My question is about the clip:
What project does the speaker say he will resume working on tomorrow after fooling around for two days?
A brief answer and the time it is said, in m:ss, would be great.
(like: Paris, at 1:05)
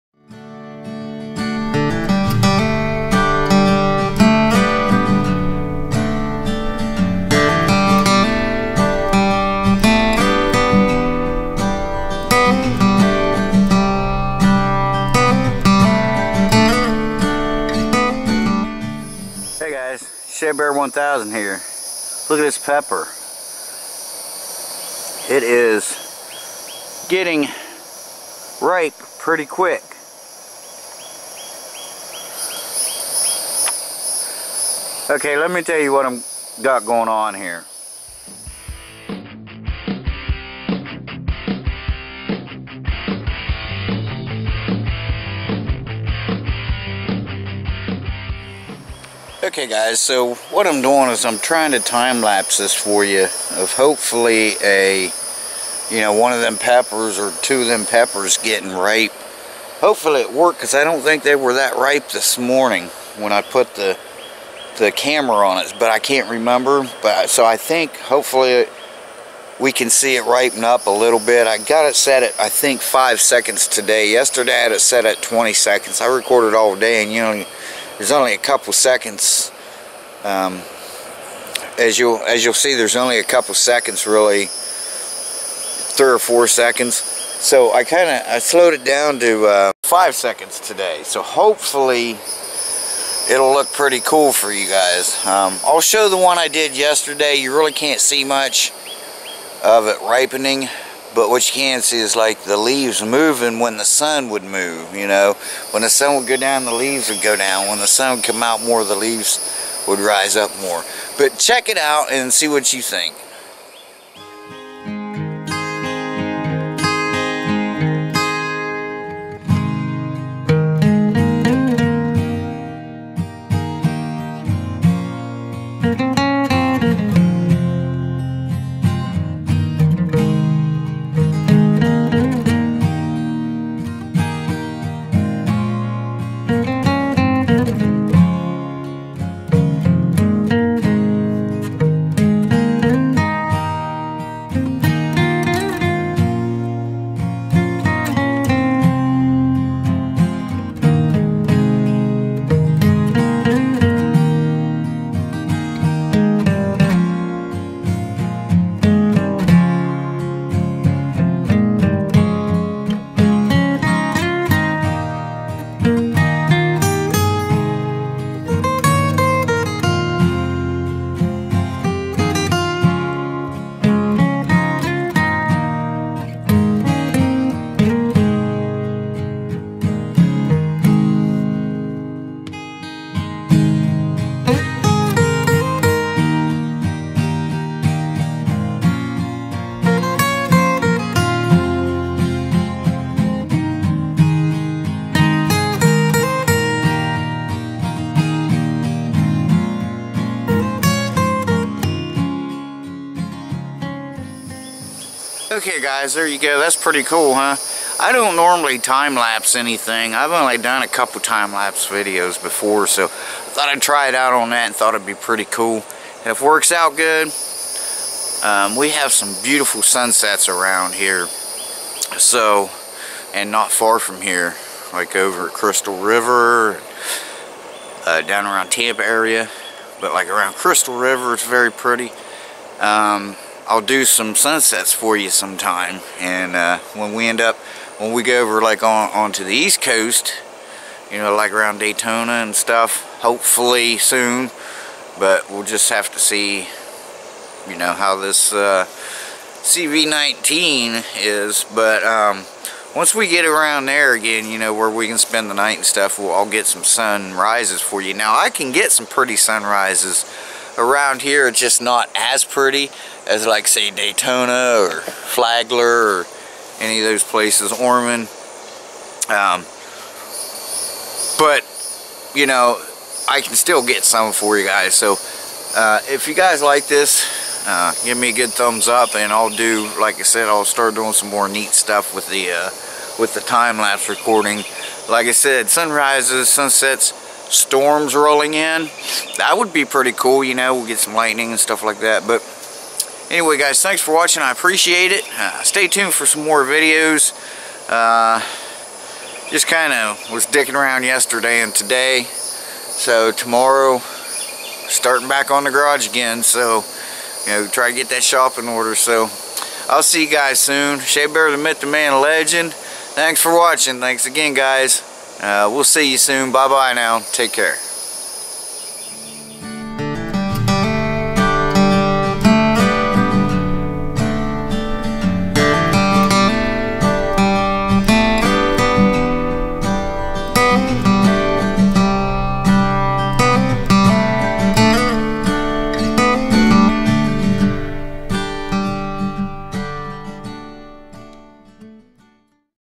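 the garage, at 5:05.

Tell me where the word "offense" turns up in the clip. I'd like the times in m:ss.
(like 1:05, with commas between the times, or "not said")
not said.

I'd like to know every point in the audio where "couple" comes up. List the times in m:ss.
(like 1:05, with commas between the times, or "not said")
1:18, 1:23, 3:30.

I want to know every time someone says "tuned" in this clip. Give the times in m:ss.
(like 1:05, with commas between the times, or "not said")
4:55.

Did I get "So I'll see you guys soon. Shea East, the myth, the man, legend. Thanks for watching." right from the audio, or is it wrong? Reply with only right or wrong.
wrong.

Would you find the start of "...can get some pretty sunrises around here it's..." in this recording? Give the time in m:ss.
4:18.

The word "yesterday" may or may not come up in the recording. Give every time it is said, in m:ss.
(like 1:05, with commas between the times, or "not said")
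1:14, 1:36, 5:01.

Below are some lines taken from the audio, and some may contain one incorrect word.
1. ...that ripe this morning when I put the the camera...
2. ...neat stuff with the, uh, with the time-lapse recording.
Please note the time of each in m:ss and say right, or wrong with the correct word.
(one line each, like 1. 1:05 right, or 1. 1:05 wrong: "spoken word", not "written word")
1. 1:01 right
2. 4:41 right.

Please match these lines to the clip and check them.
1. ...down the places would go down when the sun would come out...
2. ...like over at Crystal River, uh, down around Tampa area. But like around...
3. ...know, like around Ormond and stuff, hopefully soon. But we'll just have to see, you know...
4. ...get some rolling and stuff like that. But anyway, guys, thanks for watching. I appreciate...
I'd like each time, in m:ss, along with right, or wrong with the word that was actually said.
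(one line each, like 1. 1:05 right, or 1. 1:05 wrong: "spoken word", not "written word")
1. 1:46 wrong: "leaves", not "places"
2. 3:44 right
3. 4:01 wrong: "Daytona", not "Ormond"
4. 4:50 wrong: "lightning", not "rolling".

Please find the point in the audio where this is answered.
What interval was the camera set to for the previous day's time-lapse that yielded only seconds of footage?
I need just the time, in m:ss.
1:15.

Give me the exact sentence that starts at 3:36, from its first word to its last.
And if it works out good, um, we have some beautiful sunsets around here.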